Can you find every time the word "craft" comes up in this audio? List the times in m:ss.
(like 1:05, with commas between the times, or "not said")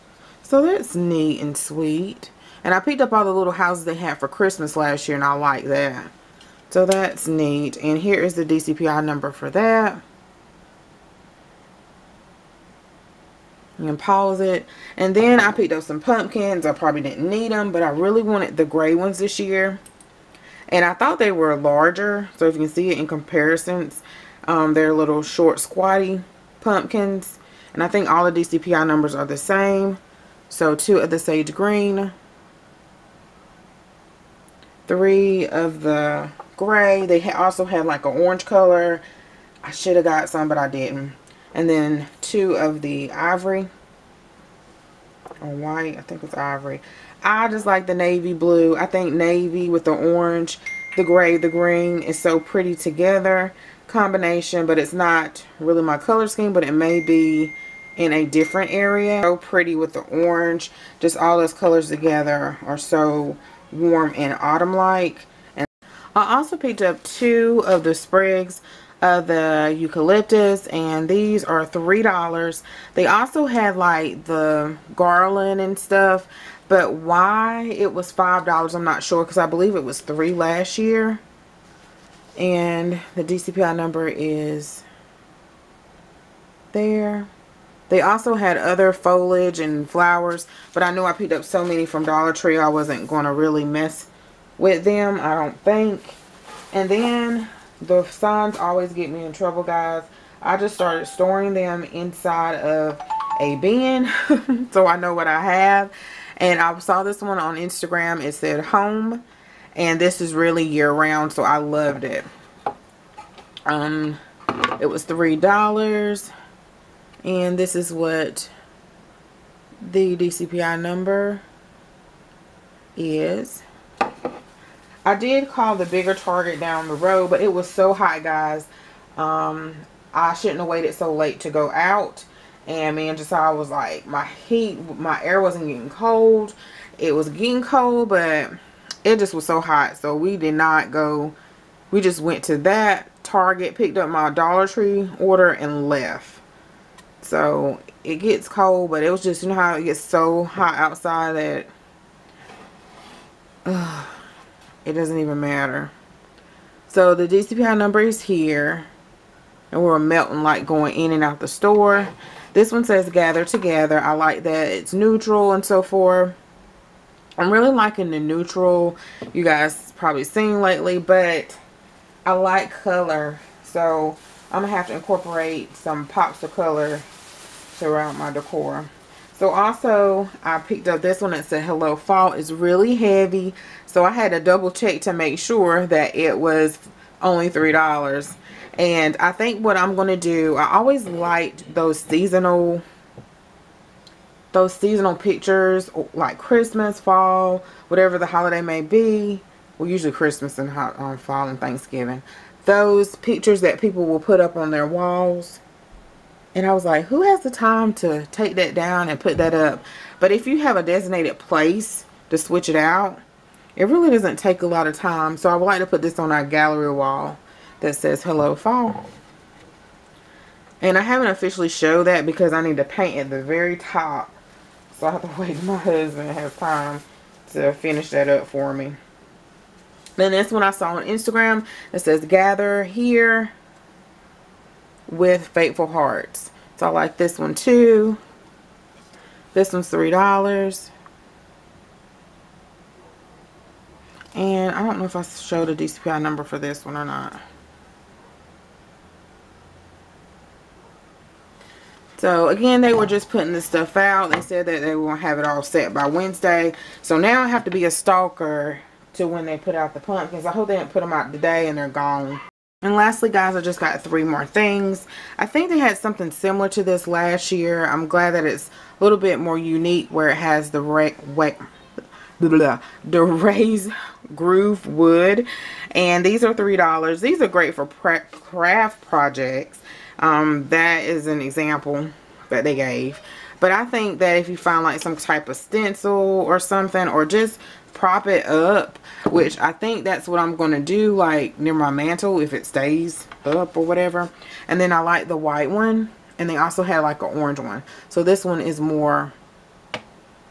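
4:37.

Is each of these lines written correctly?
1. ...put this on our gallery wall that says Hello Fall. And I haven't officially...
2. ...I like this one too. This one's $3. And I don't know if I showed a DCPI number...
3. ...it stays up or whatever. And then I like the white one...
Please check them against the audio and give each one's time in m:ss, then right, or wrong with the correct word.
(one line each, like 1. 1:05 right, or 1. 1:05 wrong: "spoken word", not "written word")
1. 3:35 right
2. 3:56 right
3. 4:52 right.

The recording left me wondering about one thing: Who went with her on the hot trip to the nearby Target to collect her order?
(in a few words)
Josiah.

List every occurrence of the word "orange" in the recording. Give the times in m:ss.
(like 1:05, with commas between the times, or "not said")
0:38, 0:49, 1:00, 4:57.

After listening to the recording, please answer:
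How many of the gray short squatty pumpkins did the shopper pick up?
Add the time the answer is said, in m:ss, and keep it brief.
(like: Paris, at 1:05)
3, at 0:34.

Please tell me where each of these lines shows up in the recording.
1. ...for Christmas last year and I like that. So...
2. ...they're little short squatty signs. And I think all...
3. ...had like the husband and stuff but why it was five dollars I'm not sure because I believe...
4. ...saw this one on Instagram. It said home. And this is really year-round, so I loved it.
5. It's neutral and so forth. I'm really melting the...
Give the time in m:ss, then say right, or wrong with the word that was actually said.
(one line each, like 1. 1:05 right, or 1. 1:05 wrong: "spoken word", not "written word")
1. 0:04 right
2. 0:24 wrong: "pumpkins", not "signs"
3. 1:13 wrong: "garland", not "husband"
4. 1:46 right
5. 2:44 wrong: "liking", not "melting".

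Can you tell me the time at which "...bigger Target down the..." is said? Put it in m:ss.
2:05.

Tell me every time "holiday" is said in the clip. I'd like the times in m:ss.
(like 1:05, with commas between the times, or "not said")
3:18.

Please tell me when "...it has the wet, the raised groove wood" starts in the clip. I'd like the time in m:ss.
4:30.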